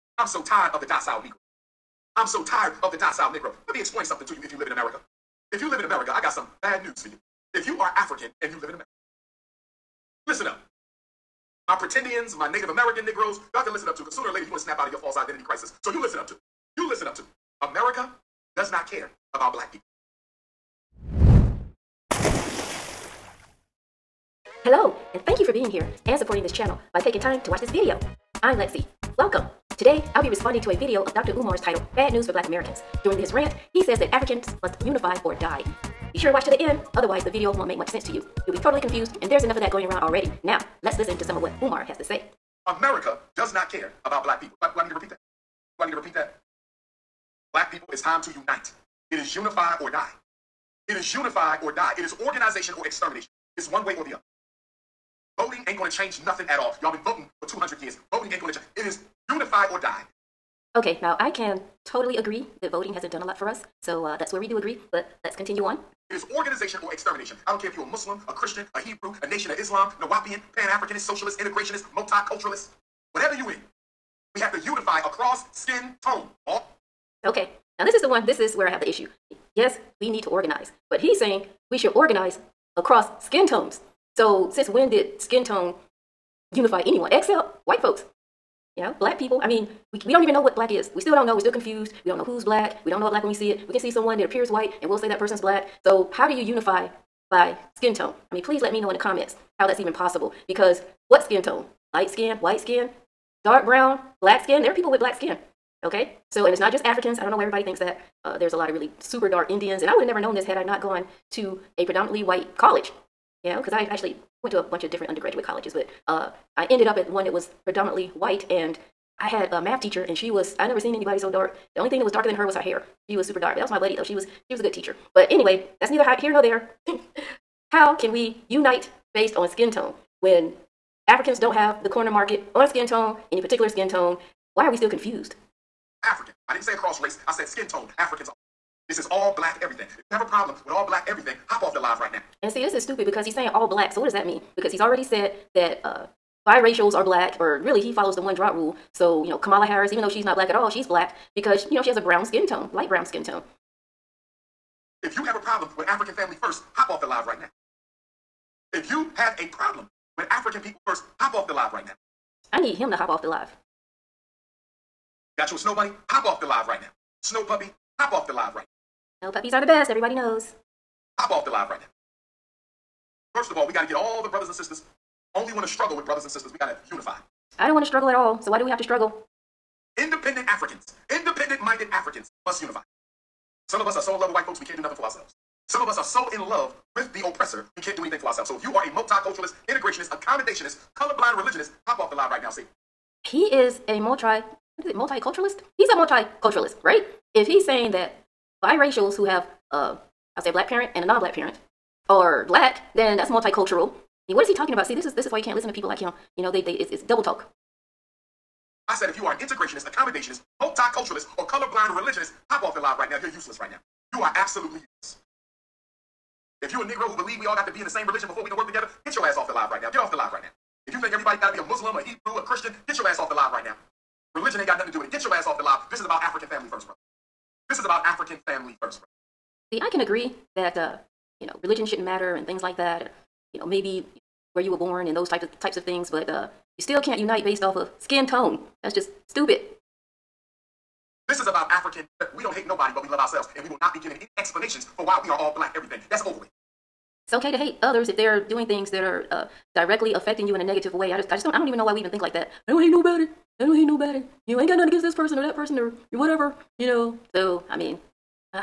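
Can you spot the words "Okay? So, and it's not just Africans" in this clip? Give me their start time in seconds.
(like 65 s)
105 s.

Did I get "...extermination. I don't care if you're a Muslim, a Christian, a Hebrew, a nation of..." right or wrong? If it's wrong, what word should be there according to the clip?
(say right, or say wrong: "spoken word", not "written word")
right.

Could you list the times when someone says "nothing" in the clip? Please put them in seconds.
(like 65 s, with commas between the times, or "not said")
56 s, 184 s, 224 s, 254 s.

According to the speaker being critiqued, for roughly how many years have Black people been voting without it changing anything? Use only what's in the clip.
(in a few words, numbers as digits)
200.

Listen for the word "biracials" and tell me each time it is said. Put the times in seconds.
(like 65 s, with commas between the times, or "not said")
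146 s, 198 s.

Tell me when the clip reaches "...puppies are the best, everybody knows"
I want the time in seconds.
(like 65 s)
169 s.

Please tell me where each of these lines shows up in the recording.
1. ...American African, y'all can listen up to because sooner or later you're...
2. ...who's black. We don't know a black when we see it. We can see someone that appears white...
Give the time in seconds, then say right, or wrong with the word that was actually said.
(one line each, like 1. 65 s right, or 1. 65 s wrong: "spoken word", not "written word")
1. 12 s wrong: "Negroes", not "African"
2. 92 s right.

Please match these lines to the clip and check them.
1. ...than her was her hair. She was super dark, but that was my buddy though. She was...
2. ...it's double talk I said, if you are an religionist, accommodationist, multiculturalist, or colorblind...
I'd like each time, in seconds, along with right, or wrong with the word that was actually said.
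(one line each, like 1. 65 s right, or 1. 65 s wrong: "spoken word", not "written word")
1. 122 s right
2. 206 s wrong: "integrationist", not "religionist".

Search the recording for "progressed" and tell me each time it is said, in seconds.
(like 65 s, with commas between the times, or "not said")
not said.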